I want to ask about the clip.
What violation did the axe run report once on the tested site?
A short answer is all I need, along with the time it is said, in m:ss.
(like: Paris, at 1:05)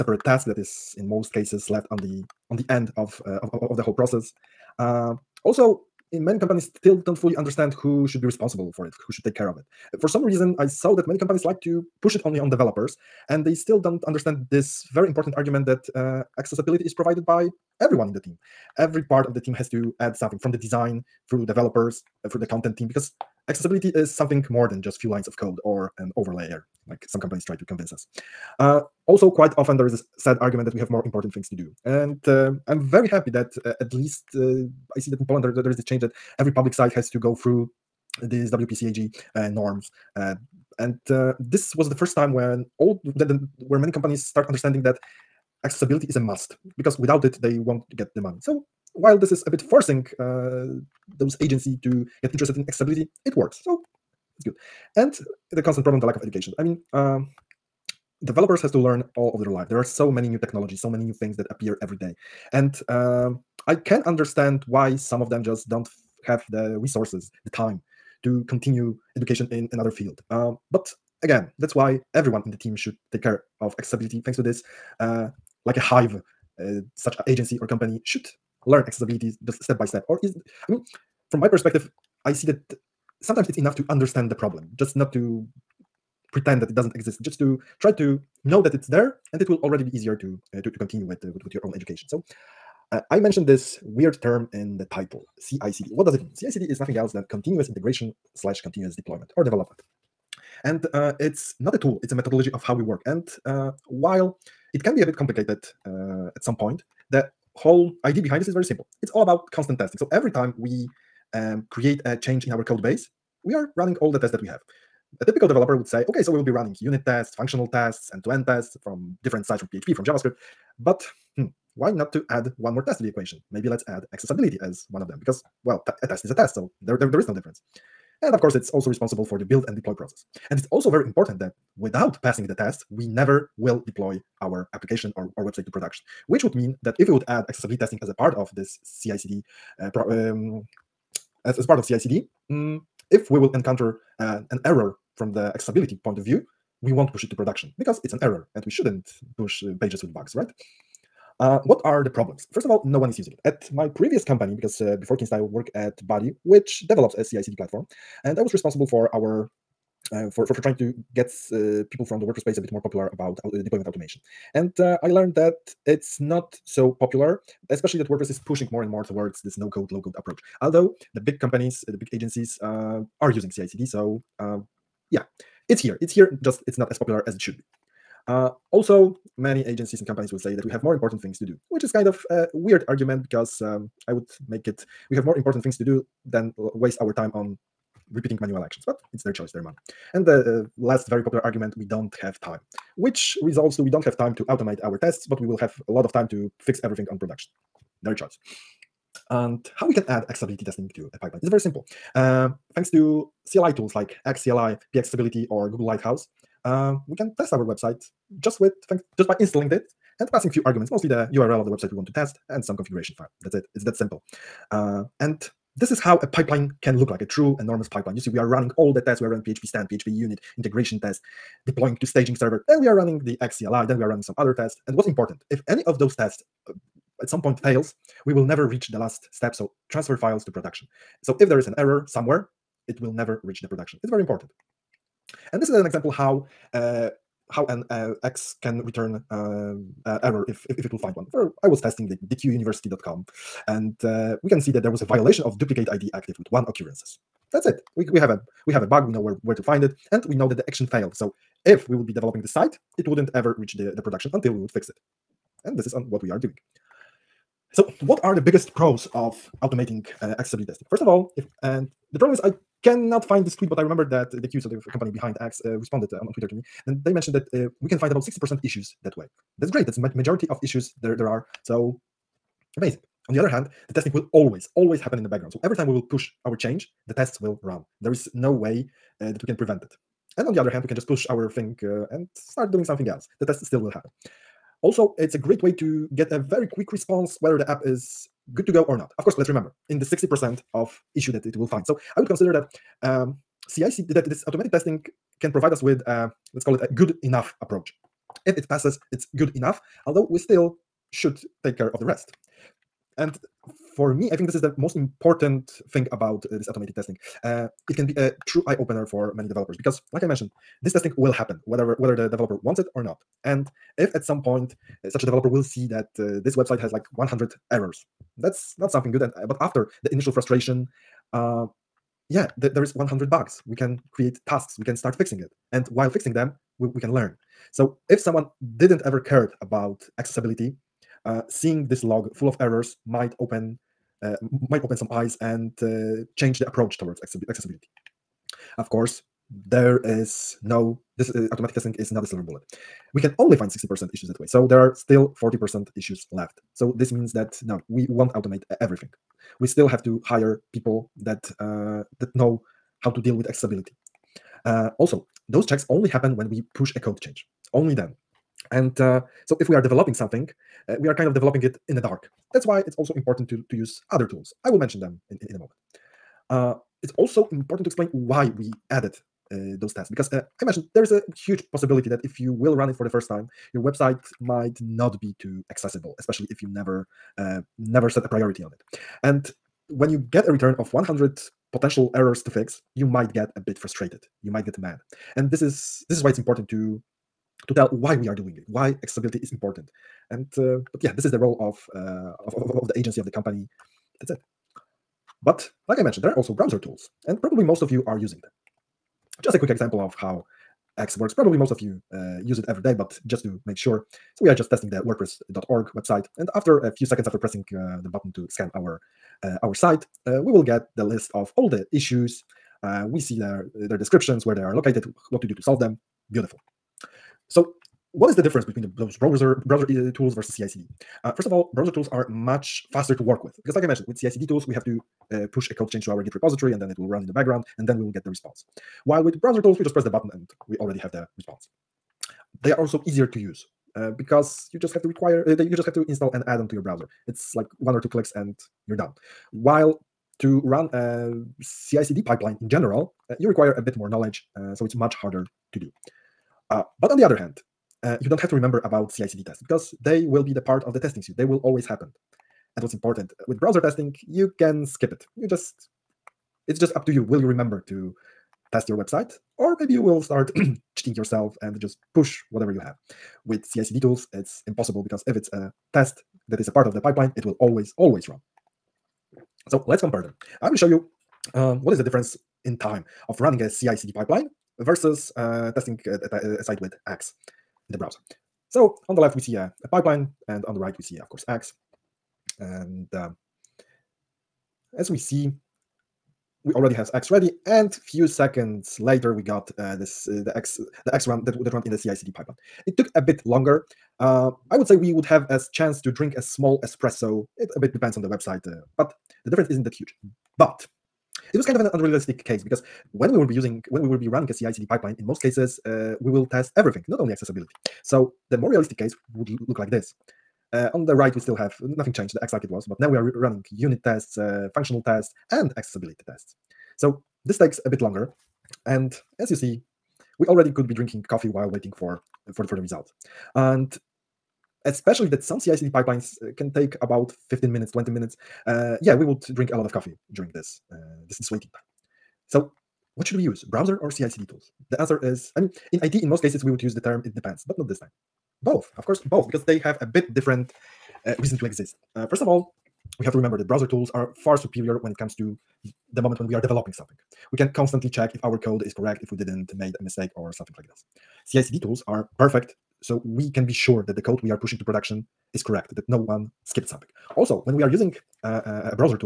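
Duplicate ID active, at 4:05.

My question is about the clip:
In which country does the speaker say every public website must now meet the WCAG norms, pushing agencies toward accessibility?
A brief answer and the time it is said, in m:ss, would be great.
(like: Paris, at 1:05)
Poland, at 0:35.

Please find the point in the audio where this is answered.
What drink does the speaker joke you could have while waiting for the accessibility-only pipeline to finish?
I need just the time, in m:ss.
8:16.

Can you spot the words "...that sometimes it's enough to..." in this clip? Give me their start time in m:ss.
1:22.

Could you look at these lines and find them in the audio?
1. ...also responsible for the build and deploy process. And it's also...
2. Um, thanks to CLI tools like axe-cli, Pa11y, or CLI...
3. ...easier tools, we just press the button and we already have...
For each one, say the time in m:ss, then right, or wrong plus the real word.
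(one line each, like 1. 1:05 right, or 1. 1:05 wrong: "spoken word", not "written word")
1. 2:08 right
2. 3:22 wrong: "Google", not "CLI"
3. 7:09 wrong: "browser", not "easier".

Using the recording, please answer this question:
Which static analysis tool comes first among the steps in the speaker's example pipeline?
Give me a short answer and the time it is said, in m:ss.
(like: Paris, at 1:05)
PHPStan, at 3:39.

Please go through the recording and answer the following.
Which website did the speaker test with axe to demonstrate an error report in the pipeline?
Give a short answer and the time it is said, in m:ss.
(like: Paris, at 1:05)
dequeuniversity.com, at 4:02.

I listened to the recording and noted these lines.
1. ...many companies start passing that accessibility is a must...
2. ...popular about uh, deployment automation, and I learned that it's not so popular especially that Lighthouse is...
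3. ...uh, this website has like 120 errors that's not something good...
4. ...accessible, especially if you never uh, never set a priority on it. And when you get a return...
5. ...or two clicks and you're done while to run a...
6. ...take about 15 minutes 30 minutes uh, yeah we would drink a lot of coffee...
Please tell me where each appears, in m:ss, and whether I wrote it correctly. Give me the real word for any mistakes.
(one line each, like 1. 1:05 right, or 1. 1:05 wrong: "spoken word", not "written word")
1. 0:43 wrong: "understanding", not "passing"
2. 2:42 wrong: "WordPress", not "Lighthouse"
3. 5:16 wrong: "100", not "120"
4. 6:15 right
5. 7:17 right
6. 8:46 wrong: "20", not "30".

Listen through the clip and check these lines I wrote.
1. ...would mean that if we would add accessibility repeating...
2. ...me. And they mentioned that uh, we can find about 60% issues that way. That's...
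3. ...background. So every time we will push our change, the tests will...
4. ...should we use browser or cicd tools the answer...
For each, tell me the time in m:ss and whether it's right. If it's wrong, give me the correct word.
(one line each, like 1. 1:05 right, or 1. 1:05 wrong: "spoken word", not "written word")
1. 2:16 wrong: "testing", not "repeating"
2. 4:26 right
3. 4:35 right
4. 8:53 right.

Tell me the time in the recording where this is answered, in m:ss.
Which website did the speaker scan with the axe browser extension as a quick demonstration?
6:45.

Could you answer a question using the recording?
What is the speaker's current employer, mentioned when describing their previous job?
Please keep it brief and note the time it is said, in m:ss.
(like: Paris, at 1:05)
Kinsta, at 2:35.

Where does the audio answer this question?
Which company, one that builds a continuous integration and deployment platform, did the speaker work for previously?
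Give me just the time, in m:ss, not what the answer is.
2:36.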